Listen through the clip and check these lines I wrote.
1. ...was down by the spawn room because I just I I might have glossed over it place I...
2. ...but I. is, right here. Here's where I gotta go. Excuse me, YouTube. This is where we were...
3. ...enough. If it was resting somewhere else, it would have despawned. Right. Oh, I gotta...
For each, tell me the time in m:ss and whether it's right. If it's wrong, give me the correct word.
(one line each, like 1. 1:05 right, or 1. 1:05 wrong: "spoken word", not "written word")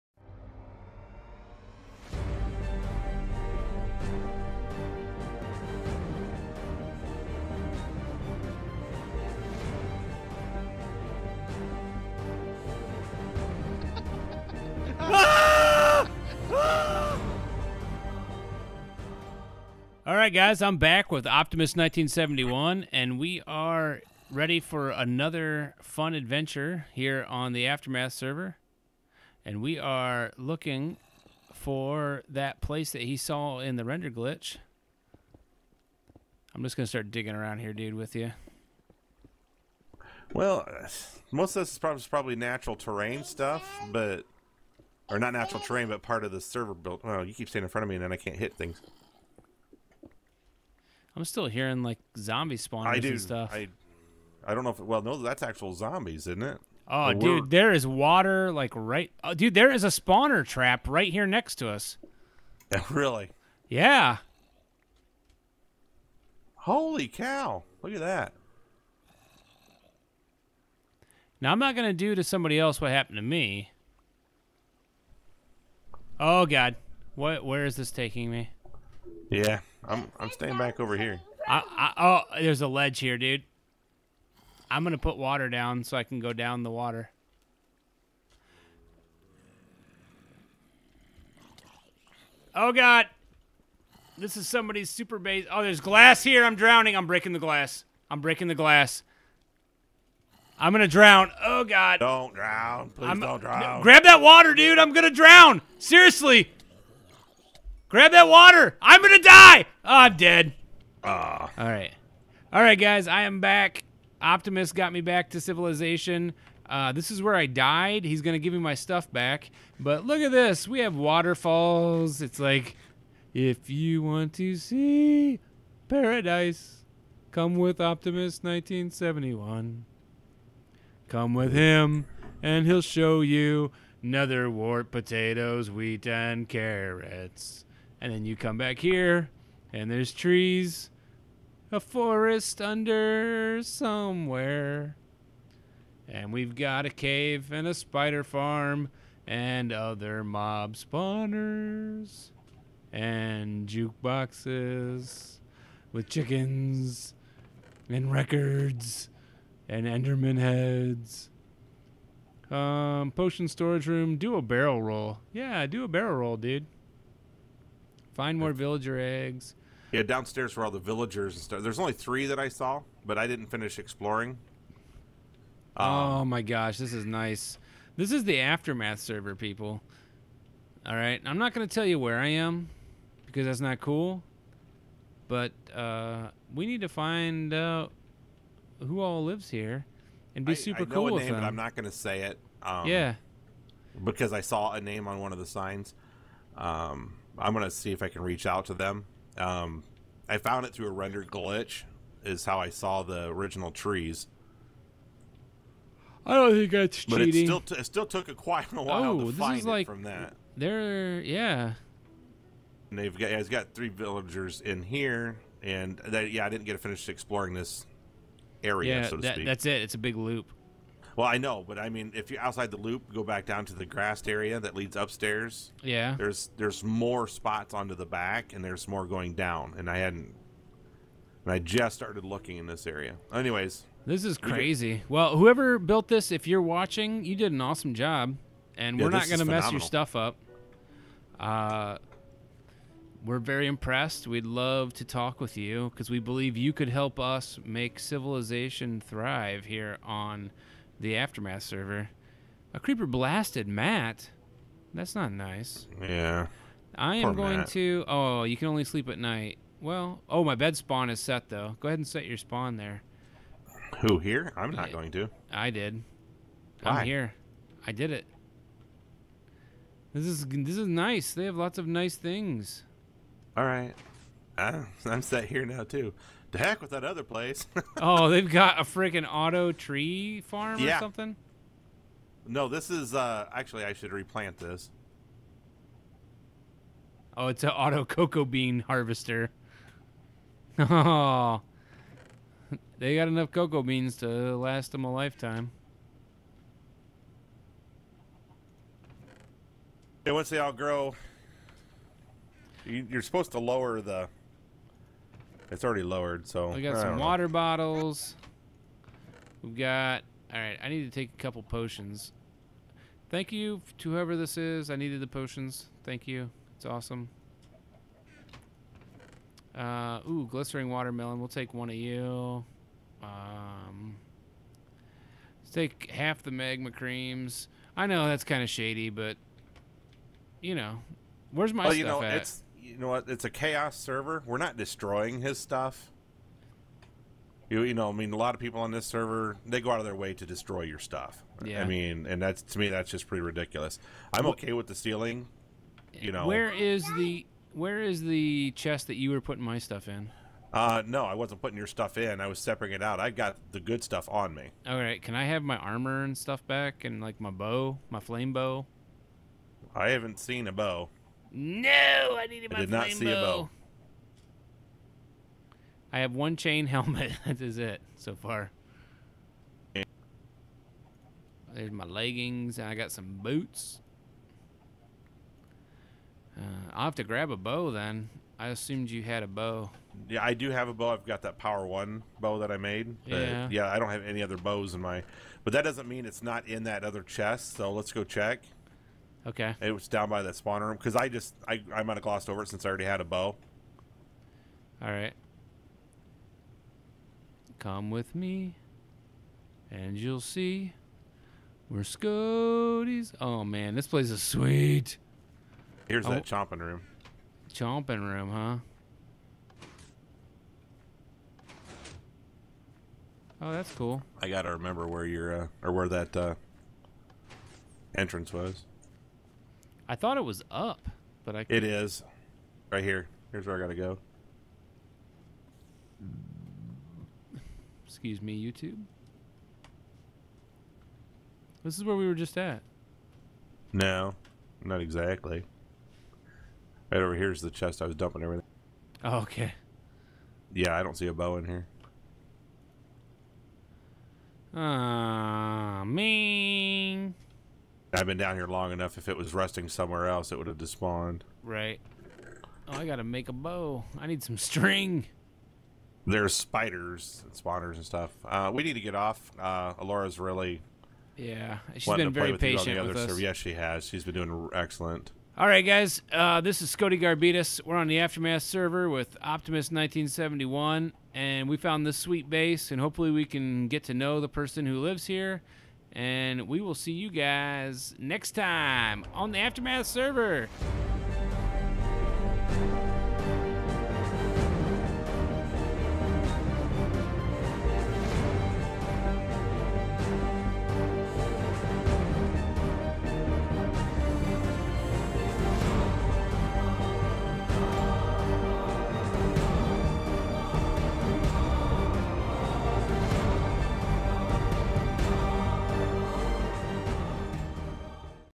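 1. 6:29 wrong: "since", not "place"
2. 7:01 right
3. 7:28 right.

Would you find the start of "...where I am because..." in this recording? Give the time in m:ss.
3:01.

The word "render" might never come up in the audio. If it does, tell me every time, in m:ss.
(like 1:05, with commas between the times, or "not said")
0:33, 3:20.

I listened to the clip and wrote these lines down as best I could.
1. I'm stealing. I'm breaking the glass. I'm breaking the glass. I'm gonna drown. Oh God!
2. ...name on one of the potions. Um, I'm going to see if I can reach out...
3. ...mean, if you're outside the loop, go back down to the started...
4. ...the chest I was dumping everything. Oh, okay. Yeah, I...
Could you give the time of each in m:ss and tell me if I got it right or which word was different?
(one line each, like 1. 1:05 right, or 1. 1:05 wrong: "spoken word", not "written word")
1. 1:36 wrong: "drowning", not "stealing"
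2. 3:14 wrong: "signs", not "potions"
3. 3:41 wrong: "grassed", not "started"
4. 7:17 right.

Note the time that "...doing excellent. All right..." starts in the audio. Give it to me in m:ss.
7:44.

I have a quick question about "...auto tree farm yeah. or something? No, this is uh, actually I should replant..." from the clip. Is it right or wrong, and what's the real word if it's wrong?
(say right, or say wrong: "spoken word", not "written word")
right.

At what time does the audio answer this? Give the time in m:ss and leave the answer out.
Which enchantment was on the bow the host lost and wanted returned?
5:58.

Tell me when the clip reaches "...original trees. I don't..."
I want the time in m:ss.
3:23.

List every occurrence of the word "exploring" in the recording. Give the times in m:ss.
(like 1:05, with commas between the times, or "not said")
2:53, 3:37.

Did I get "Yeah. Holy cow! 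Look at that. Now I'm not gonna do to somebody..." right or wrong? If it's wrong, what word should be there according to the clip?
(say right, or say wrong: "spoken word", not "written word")
right.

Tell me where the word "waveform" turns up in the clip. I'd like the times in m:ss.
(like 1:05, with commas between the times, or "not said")
not said.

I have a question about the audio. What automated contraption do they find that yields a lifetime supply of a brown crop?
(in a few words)
auto cocoa bean harvester.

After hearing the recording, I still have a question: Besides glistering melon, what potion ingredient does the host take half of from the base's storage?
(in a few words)
magma creams.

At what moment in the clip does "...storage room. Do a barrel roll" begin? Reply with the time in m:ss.
2:43.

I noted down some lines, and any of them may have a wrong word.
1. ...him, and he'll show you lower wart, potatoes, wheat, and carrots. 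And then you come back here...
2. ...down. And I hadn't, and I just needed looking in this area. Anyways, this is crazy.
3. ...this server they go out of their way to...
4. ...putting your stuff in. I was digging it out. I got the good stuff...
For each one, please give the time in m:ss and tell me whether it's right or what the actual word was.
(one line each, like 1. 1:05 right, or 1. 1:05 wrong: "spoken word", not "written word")
1. 2:11 wrong: "nether", not "lower"
2. 3:49 wrong: "started", not "needed"
3. 5:38 right
4. 5:51 wrong: "separating", not "digging".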